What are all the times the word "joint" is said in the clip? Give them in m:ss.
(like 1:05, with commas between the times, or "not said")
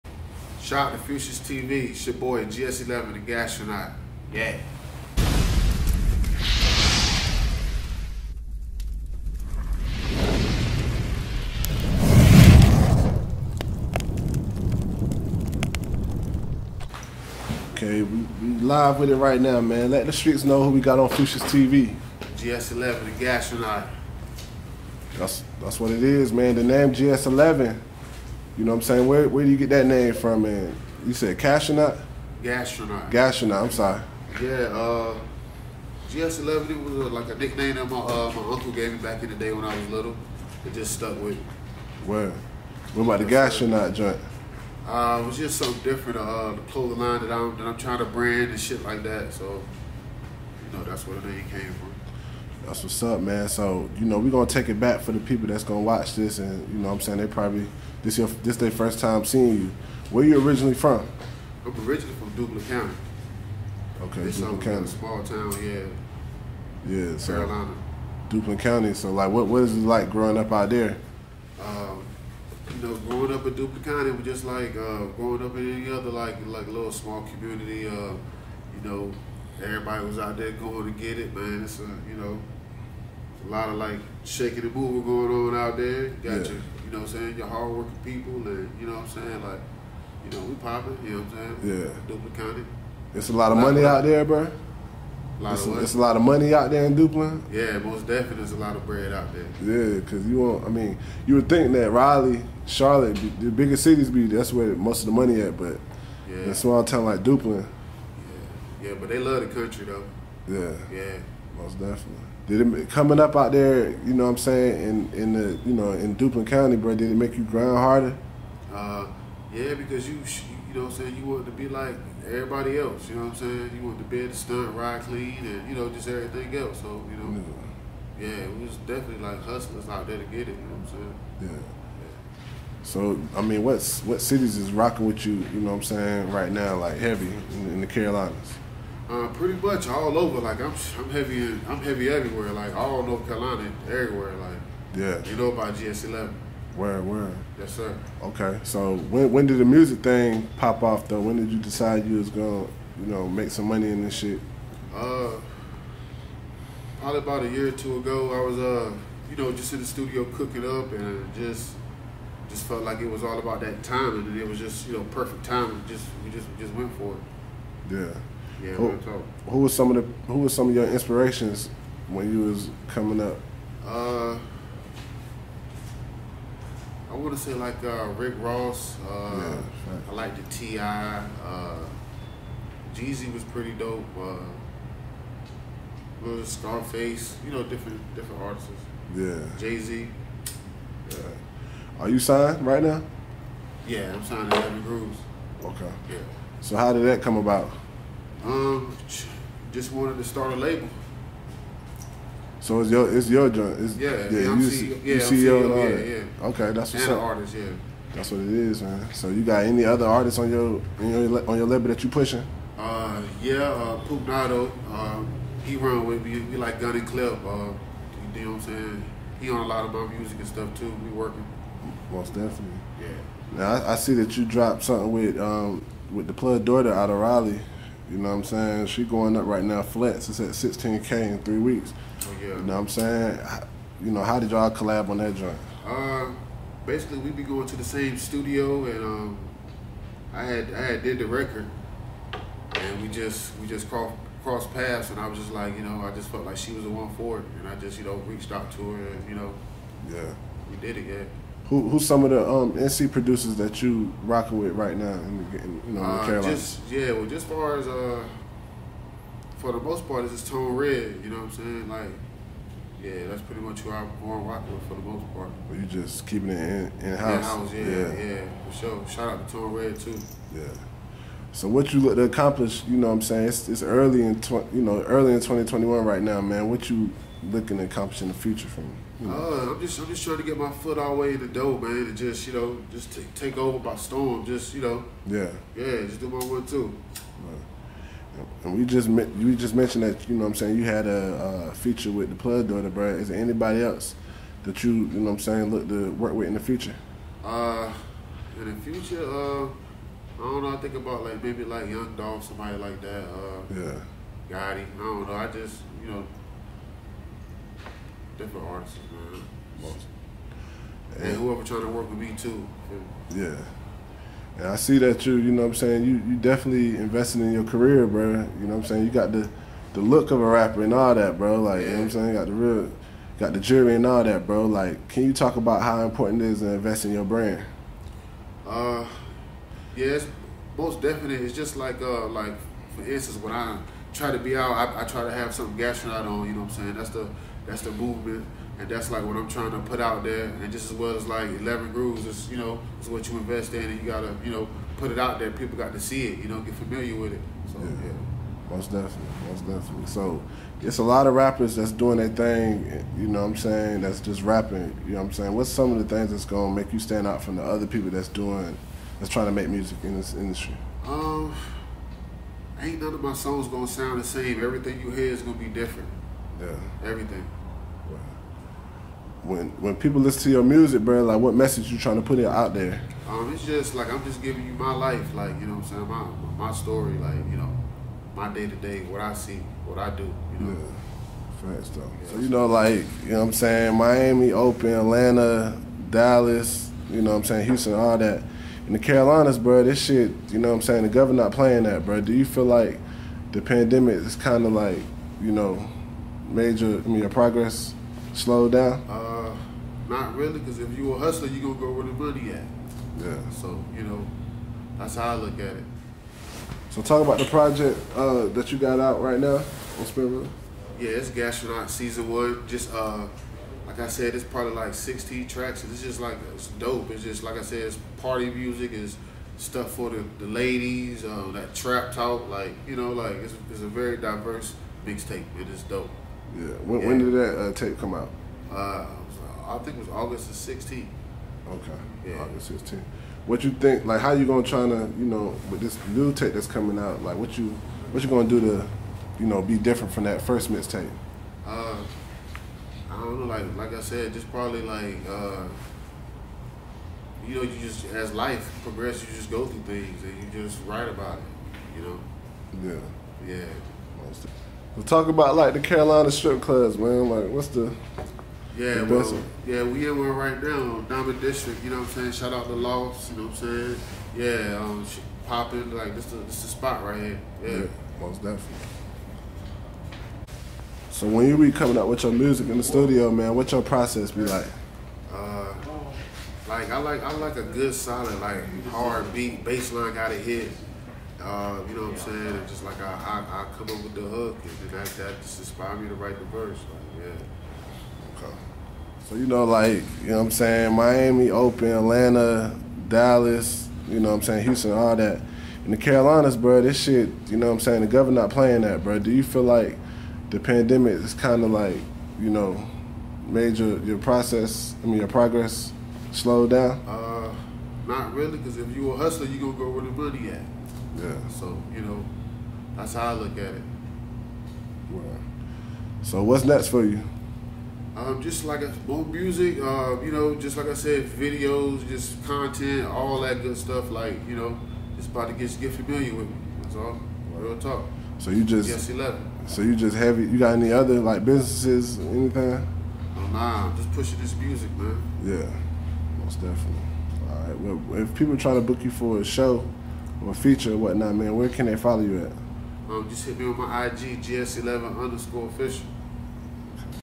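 0:43, 3:23, 3:55.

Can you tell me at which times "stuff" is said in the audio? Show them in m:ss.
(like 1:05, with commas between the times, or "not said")
3:40, 6:59, 8:43.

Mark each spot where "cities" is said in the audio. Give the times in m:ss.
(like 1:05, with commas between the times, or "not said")
1:43, 2:14.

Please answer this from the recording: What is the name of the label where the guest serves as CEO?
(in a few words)
Heavy Grooves.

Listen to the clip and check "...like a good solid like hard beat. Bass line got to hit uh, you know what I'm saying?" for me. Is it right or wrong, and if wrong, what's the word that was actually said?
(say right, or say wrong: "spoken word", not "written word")
right.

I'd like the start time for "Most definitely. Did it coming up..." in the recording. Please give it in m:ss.
1:51.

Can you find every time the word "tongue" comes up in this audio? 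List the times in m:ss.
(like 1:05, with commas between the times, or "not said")
not said.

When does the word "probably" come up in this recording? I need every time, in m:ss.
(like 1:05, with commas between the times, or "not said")
0:57, 2:37, 6:54, 7:24.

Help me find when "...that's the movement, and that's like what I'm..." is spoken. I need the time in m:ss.
5:37.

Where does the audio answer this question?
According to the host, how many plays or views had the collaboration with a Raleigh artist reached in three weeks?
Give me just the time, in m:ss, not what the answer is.
3:50.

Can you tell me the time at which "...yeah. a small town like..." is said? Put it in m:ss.
1:46.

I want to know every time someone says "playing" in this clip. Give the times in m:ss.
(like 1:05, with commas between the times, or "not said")
6:31, 8:18.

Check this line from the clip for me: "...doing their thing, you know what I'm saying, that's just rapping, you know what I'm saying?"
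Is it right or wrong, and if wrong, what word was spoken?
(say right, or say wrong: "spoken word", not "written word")
right.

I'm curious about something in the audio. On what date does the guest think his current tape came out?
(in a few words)
August 16.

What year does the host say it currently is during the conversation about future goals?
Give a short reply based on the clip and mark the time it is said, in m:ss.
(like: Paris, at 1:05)
2021, at 4:35.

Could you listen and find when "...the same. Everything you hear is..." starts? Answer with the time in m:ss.
6:04.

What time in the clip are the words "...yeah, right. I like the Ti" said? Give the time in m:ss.
2:59.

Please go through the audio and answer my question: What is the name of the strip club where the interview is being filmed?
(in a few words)
Diamond District.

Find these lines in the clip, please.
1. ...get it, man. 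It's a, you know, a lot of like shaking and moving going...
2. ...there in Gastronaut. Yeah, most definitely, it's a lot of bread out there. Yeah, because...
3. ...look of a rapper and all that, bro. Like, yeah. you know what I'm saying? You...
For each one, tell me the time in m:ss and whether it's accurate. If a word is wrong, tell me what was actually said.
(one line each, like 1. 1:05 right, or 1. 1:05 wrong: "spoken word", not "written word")
1. 1:20 right
2. 1:36 wrong: "Duplin", not "Gastronaut"
3. 5:20 right.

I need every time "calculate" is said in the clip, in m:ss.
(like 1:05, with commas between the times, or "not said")
not said.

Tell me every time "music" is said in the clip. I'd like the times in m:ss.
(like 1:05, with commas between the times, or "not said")
2:29, 3:40, 5:59, 6:10, 6:58, 7:52, 8:39, 8:54.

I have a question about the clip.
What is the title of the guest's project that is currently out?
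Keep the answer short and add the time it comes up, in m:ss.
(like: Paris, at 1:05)
Gastronaut Season One, at 6:51.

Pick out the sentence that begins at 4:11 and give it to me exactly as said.
Who who's some of the um, NC producers that you rocking with right now in, in you know in uh, Carolina?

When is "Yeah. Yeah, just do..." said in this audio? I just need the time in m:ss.
4:45.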